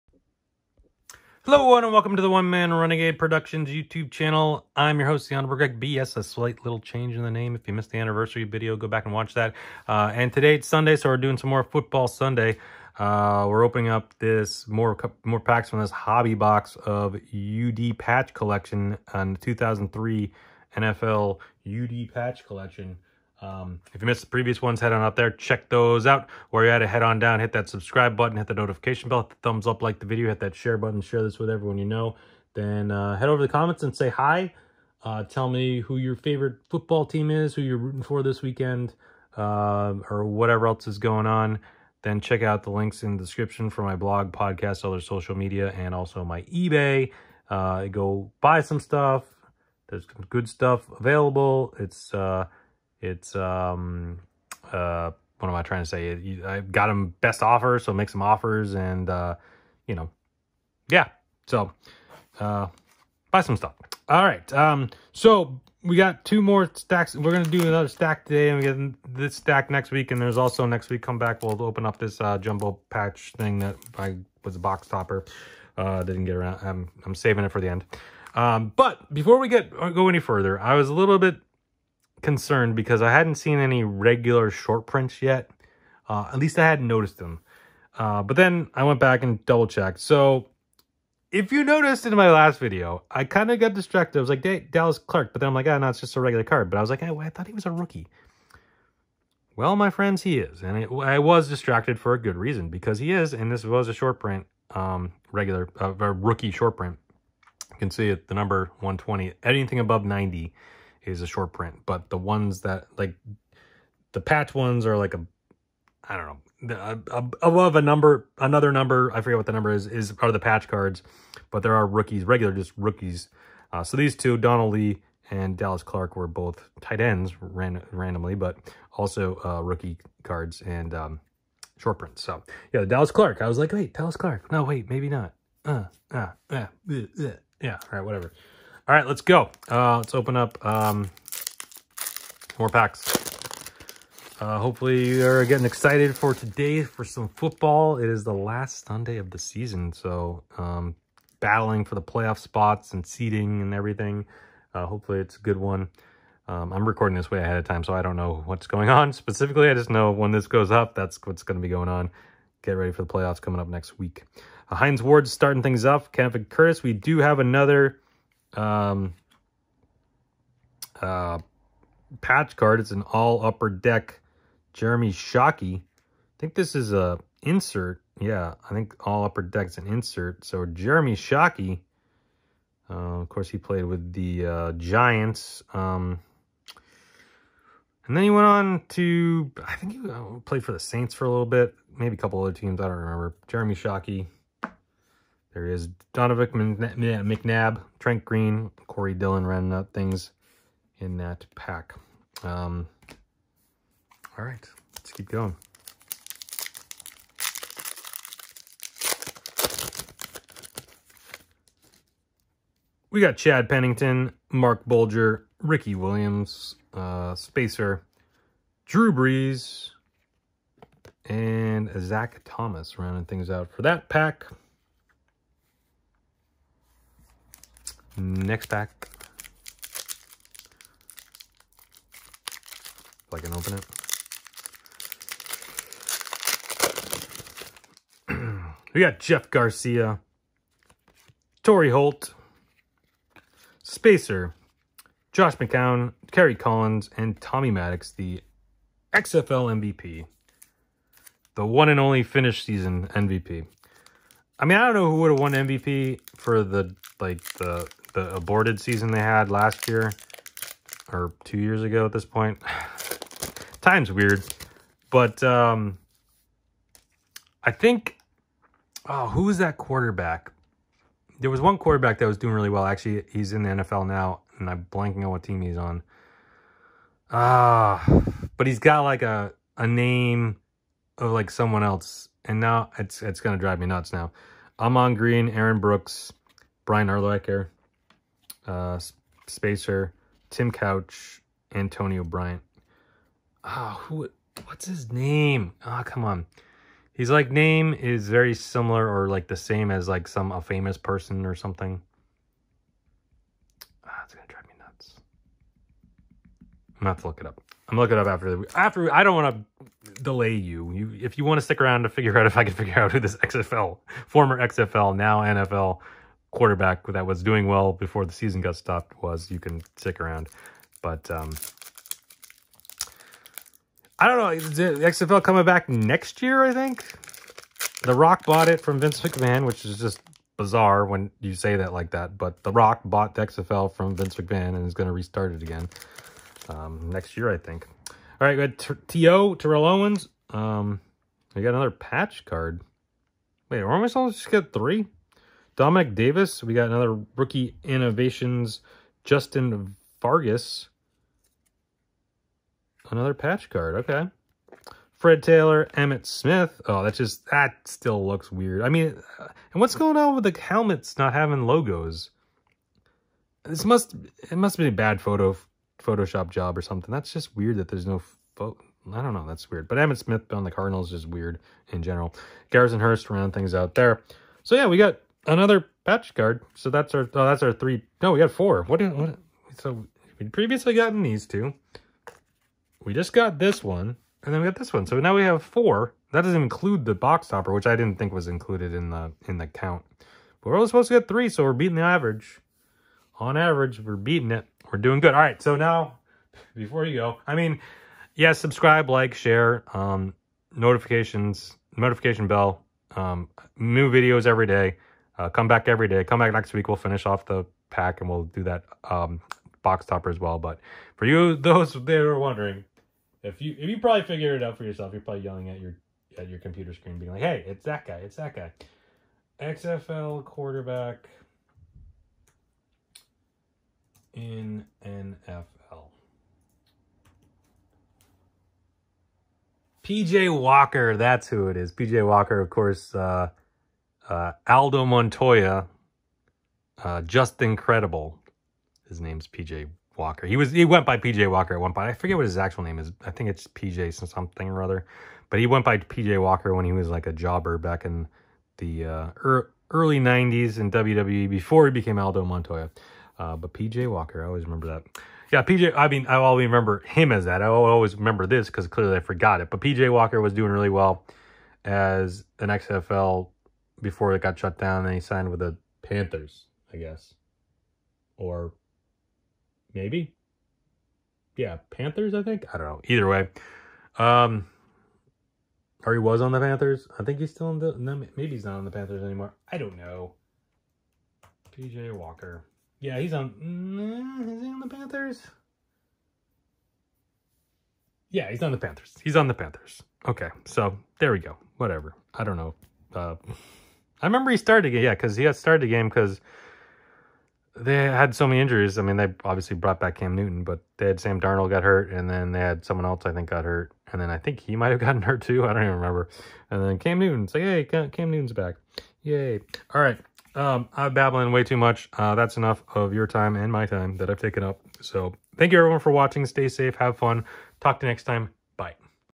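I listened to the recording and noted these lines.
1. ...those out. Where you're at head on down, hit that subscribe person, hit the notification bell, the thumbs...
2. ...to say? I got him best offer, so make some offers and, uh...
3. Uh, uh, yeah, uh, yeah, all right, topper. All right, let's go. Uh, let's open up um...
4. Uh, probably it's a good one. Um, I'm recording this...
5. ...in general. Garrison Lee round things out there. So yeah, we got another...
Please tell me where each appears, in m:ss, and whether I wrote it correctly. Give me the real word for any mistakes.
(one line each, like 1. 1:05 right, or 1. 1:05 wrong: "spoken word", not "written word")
1. 0:25 wrong: "button", not "person"
2. 0:55 right
3. 2:15 wrong: "whatever", not "topper"
4. 2:34 wrong: "hopefully", not "probably"
5. 6:11 wrong: "Hearst", not "Lee".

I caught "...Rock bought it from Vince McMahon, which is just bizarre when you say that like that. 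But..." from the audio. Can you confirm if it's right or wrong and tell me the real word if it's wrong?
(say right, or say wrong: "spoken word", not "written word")
right.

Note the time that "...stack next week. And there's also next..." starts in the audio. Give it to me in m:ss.
1:09.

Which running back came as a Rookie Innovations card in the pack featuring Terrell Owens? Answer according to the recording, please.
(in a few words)
Justin Fargas.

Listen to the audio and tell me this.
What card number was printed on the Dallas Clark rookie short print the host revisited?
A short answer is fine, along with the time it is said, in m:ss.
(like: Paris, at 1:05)
120, at 1:48.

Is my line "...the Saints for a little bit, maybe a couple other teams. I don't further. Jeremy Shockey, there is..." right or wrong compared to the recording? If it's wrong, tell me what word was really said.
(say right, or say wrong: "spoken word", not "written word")
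wrong: "remember", not "further".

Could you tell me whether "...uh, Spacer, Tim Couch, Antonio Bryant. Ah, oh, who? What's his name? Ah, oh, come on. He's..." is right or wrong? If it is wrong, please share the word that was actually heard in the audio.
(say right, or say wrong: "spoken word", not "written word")
right.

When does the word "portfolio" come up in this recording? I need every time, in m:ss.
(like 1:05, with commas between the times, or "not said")
not said.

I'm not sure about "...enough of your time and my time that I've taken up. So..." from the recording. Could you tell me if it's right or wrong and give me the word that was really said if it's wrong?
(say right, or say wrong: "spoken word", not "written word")
right.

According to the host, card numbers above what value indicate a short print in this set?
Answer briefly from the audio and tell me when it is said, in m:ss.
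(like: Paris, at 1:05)
90, at 1:50.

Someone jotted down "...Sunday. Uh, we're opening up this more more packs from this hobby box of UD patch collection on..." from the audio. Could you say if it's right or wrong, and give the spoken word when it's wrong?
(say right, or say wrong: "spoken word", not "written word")
right.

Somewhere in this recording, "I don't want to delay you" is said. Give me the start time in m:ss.
5:09.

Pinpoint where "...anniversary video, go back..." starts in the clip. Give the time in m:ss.
0:07.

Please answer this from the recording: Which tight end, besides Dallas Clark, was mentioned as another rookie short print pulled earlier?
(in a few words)
Donald Lee.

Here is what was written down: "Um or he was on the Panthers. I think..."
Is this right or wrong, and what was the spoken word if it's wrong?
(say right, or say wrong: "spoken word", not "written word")
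right.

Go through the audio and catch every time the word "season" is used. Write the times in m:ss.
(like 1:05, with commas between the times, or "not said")
2:29, 4:12, 4:18, 5:18.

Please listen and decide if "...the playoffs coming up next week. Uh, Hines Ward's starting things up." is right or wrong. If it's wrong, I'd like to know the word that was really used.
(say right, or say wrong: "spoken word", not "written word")
right.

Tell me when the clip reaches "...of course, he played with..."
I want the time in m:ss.
3:03.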